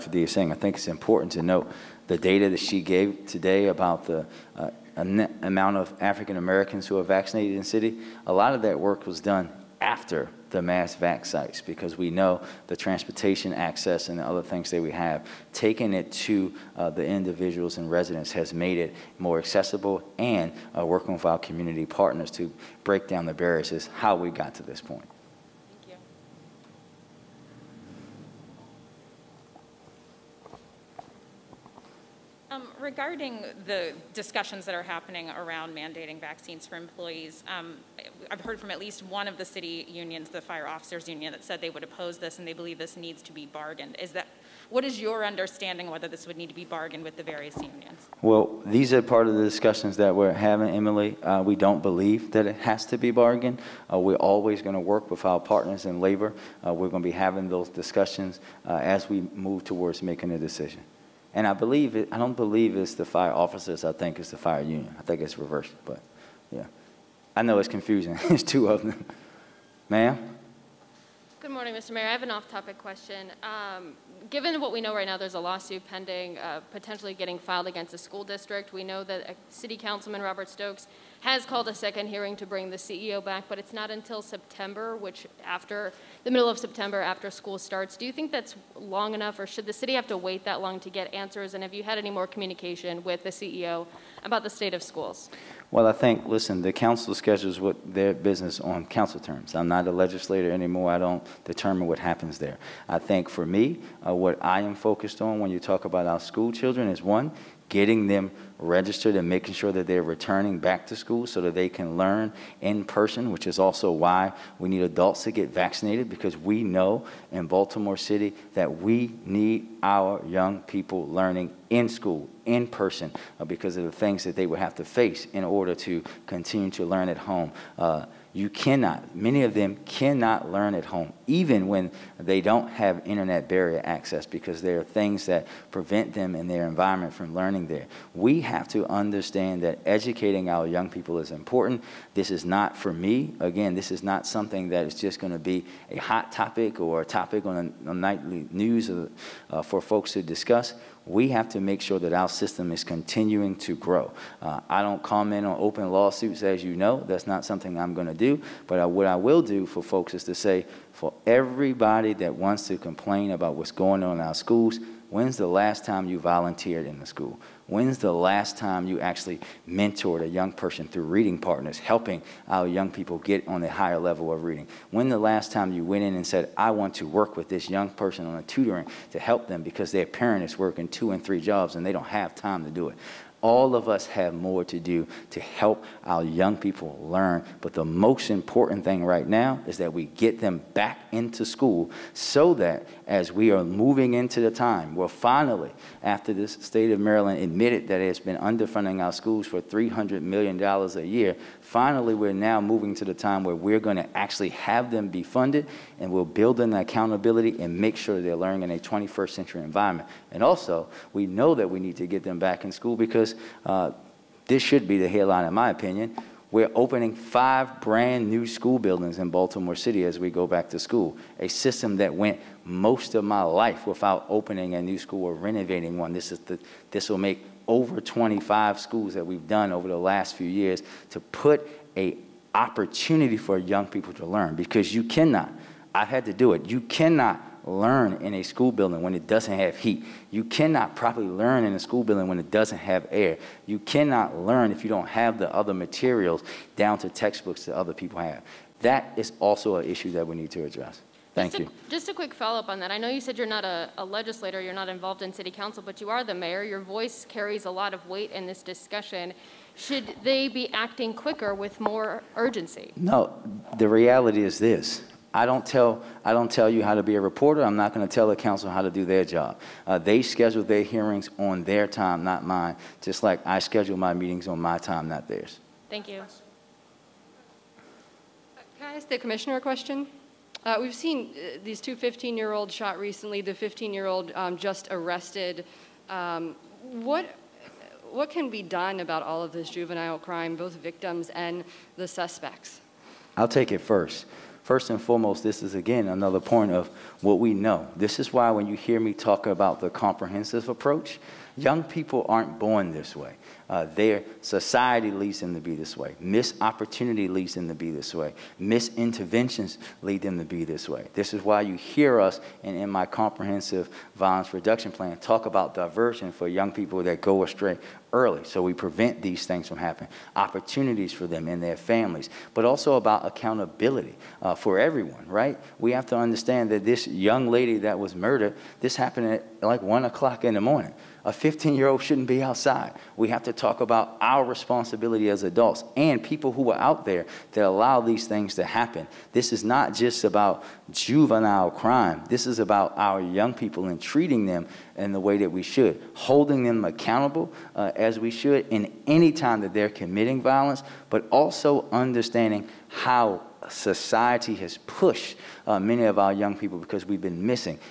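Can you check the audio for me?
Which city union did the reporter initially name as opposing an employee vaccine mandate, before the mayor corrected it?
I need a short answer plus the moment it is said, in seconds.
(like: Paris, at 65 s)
Fire officers union, at 40 s.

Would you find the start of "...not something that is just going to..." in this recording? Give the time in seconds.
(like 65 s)
144 s.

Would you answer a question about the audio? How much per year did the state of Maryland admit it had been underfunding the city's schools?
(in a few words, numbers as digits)
$300 million.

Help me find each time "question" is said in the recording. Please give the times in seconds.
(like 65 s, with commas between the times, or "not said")
72 s, 279 s.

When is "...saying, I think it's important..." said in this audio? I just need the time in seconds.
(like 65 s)
0 s.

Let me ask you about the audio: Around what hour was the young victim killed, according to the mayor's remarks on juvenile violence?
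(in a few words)
1 o'clock in the morning.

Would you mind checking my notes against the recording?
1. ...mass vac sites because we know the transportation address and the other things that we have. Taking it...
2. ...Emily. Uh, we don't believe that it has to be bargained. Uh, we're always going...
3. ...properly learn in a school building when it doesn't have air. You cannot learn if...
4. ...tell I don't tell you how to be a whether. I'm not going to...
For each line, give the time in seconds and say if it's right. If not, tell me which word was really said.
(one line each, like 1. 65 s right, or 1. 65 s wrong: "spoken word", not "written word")
1. 10 s wrong: "access", not "address"
2. 50 s right
3. 240 s right
4. 265 s wrong: "reporter", not "whether".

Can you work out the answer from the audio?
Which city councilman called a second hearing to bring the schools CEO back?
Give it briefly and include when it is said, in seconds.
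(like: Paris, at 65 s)
Robert Stokes, at 80 s.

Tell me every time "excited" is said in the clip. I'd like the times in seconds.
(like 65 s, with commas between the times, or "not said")
not said.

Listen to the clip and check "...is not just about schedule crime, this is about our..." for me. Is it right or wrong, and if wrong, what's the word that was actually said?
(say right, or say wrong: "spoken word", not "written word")
wrong: "juvenile", not "schedule".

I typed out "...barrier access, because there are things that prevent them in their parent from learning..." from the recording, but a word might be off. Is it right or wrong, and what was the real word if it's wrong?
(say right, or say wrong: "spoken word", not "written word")
wrong: "environment", not "parent".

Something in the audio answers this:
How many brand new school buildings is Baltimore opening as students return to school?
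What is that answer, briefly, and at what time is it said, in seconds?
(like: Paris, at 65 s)
5, at 217 s.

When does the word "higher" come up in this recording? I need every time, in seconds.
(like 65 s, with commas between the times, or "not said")
173 s.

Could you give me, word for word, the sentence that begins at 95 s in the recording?
Well, I think, listen, the council schedules what their business on council terms.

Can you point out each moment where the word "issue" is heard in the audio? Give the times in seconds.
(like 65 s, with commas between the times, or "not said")
249 s.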